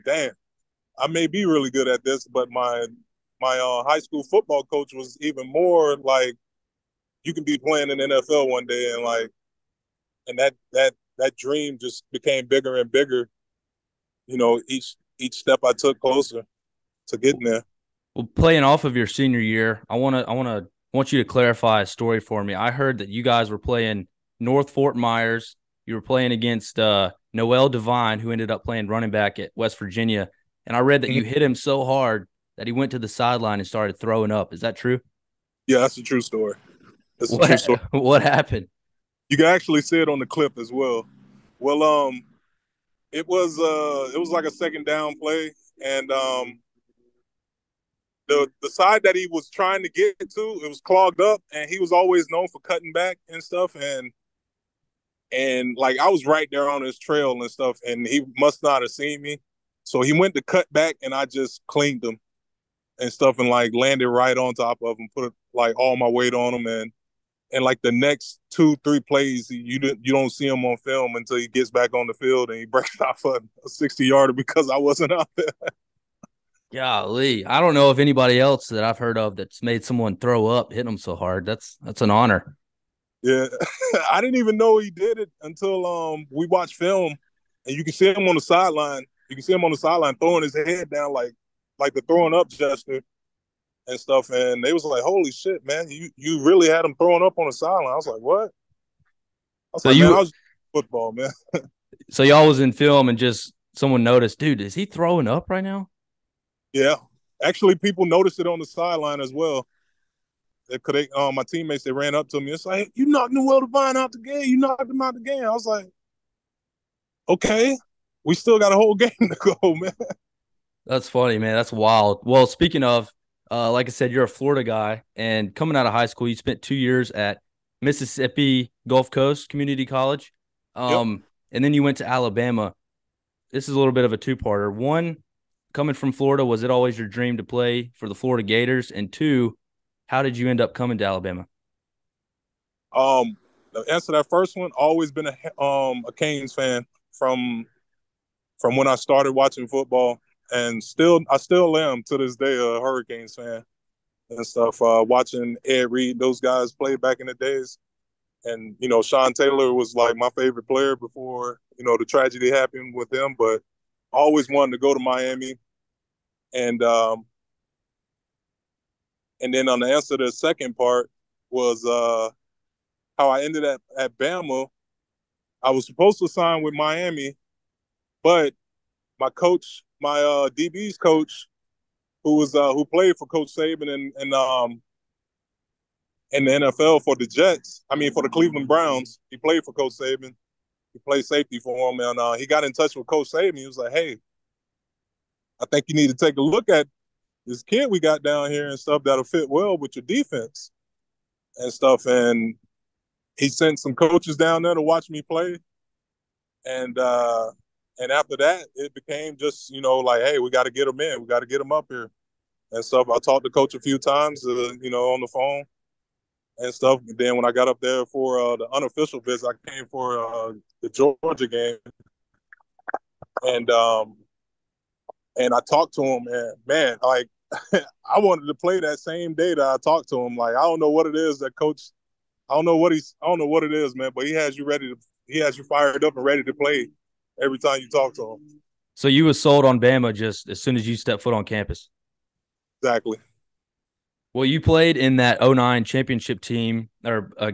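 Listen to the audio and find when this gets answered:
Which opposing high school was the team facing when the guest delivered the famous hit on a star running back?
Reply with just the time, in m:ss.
0:24.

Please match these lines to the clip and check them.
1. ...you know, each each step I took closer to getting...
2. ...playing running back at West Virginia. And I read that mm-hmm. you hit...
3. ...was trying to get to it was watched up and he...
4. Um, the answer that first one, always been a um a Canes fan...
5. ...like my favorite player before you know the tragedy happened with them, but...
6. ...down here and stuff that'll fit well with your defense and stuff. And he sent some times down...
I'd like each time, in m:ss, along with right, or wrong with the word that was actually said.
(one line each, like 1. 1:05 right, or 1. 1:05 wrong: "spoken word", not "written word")
1. 0:14 right
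2. 0:28 right
3. 0:49 wrong: "clogged", not "watched"
4. 2:22 right
5. 2:39 right
6. 3:18 wrong: "coaches", not "times".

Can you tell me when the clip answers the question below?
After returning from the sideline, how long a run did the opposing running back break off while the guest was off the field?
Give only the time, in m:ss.
1:13.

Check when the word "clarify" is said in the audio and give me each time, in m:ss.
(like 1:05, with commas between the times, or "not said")
0:21.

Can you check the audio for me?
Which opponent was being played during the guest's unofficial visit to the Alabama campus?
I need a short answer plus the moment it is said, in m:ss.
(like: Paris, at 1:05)
Georgia, at 3:40.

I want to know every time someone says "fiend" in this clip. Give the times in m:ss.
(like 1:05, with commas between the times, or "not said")
not said.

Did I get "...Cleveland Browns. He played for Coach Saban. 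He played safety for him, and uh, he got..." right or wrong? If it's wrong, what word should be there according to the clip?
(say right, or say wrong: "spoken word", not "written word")
right.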